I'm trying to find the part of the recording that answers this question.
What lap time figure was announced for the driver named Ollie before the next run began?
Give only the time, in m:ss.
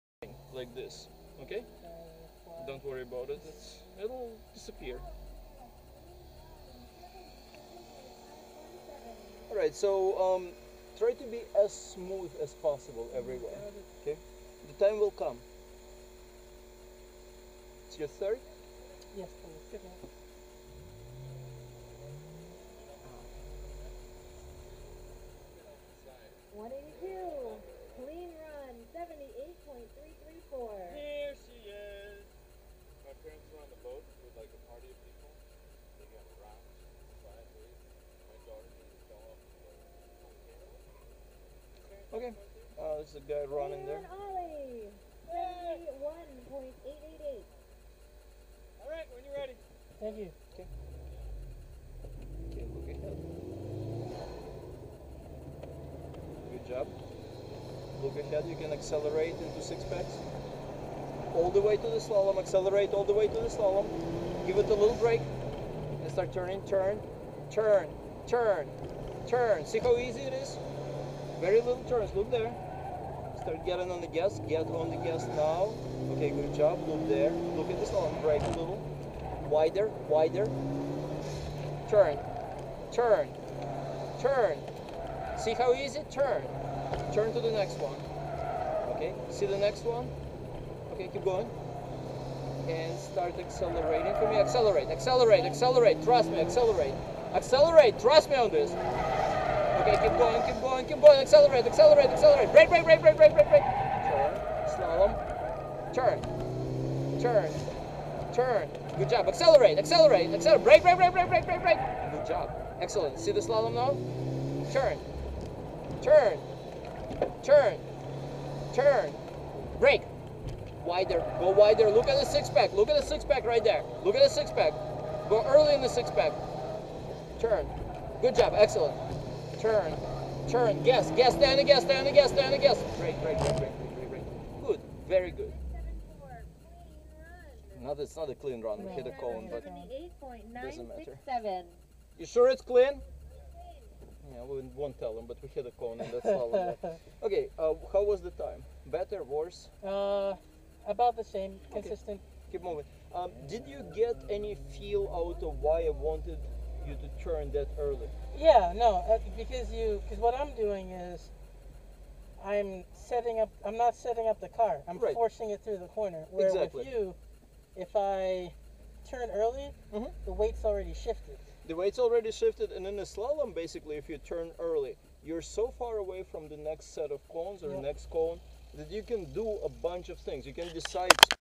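0:45.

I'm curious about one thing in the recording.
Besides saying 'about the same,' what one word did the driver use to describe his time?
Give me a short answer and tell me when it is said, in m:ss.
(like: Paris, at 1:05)
consistent, at 2:31.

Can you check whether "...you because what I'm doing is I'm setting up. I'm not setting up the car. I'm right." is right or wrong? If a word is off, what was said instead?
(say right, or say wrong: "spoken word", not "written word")
right.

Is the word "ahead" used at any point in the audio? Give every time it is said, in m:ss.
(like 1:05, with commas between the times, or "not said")
0:52, 0:58.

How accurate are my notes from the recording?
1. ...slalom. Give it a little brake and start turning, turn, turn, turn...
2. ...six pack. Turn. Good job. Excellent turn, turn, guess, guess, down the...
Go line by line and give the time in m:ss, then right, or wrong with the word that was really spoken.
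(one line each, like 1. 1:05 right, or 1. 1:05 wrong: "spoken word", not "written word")
1. 1:03 right
2. 2:05 right.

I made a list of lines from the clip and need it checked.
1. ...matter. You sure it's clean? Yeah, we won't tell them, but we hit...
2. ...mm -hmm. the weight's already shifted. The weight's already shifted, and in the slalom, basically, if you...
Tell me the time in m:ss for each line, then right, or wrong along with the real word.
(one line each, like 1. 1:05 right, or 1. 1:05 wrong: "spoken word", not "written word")
1. 2:20 right
2. 2:49 right.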